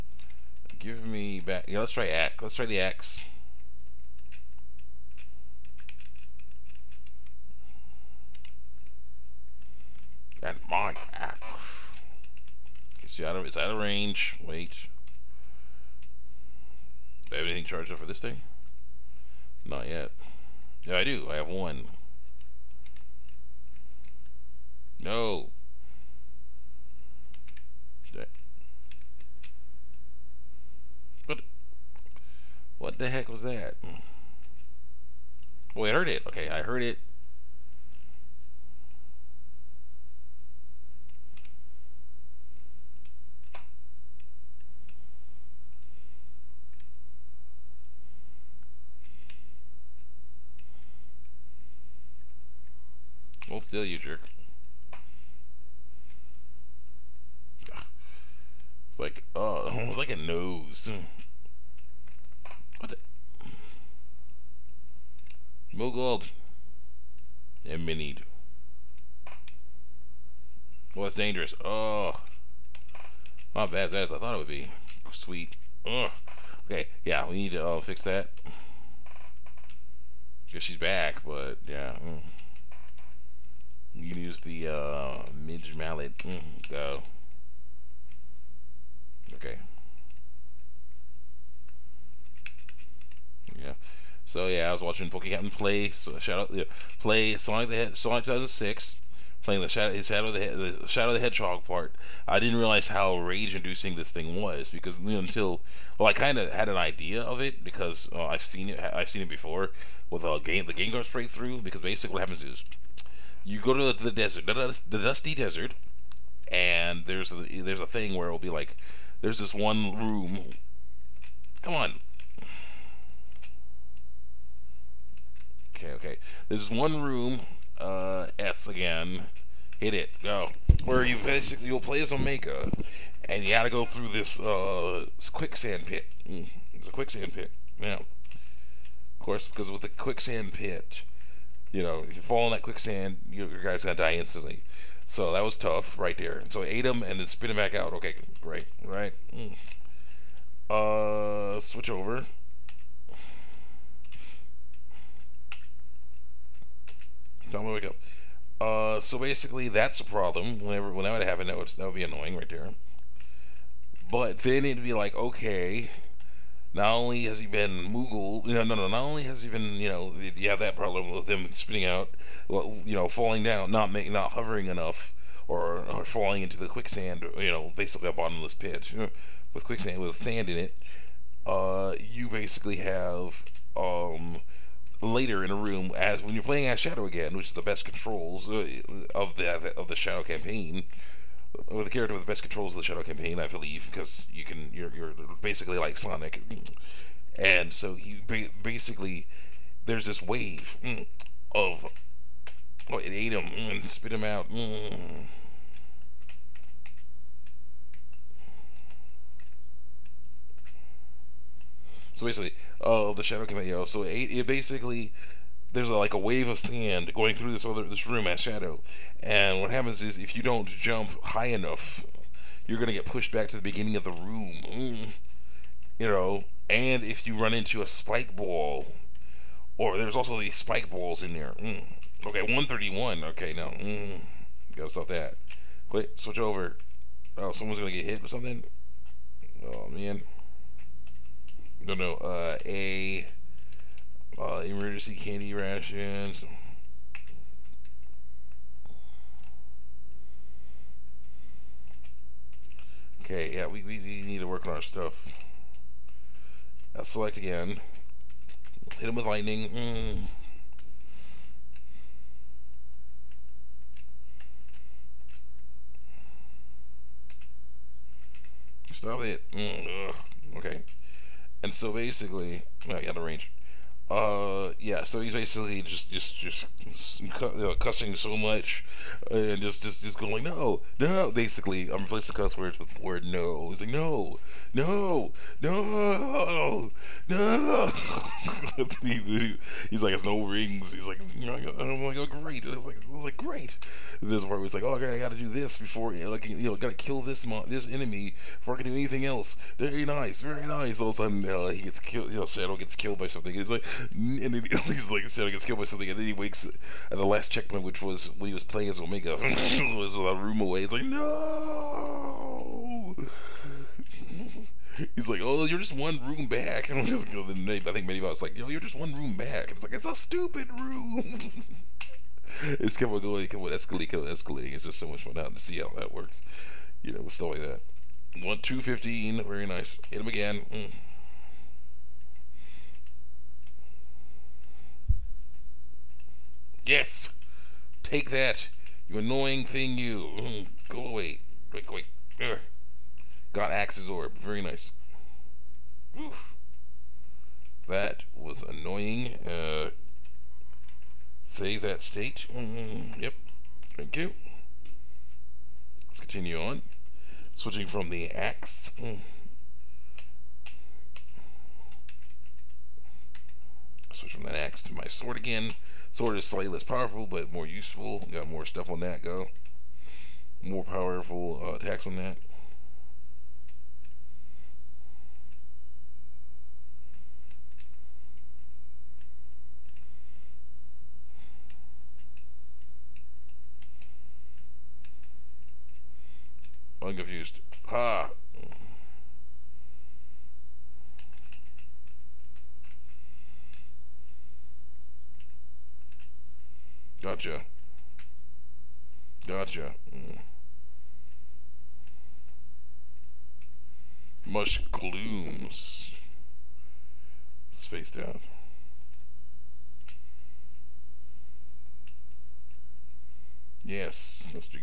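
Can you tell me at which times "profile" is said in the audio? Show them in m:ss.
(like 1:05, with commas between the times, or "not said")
not said.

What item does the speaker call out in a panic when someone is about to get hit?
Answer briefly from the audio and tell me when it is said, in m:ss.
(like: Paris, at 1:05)
emergency candy rations, at 4:04.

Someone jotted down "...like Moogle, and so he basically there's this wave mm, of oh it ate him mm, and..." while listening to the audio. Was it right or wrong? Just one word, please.
wrong.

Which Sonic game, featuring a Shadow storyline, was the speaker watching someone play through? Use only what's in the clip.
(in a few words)
Sonic 2006.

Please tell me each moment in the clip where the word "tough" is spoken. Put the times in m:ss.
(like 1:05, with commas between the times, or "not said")
2:25.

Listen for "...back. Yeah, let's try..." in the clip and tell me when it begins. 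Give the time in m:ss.
0:01.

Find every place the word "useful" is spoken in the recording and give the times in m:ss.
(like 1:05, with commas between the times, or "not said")
6:07.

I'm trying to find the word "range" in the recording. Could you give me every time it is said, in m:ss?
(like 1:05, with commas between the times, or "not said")
0:13, 4:33.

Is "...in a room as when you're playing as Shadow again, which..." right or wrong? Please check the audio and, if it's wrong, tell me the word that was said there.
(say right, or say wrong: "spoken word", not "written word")
right.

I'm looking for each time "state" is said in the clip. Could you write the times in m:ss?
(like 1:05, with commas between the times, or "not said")
5:52.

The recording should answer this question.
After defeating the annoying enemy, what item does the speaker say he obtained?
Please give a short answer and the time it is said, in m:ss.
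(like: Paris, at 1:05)
Axe's Orb, at 5:43.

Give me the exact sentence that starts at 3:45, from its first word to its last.
you know and if you run into a spike ball or there's also these spike balls in there mm.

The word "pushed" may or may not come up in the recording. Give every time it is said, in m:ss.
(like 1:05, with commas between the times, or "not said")
3:43.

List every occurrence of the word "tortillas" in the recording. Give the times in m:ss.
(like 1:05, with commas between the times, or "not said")
not said.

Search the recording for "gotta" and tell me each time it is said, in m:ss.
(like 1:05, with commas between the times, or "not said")
2:13, 3:54.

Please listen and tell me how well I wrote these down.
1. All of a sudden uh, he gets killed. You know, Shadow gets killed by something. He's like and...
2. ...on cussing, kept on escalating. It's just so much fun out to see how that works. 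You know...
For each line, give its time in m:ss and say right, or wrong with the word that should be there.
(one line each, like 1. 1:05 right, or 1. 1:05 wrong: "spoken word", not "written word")
1. 5:01 right
2. 5:23 wrong: "escalating", not "cussing".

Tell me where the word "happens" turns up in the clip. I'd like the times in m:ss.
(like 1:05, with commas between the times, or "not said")
1:52, 2:41, 3:39.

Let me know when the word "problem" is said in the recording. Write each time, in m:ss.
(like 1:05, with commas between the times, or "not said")
2:40, 2:50.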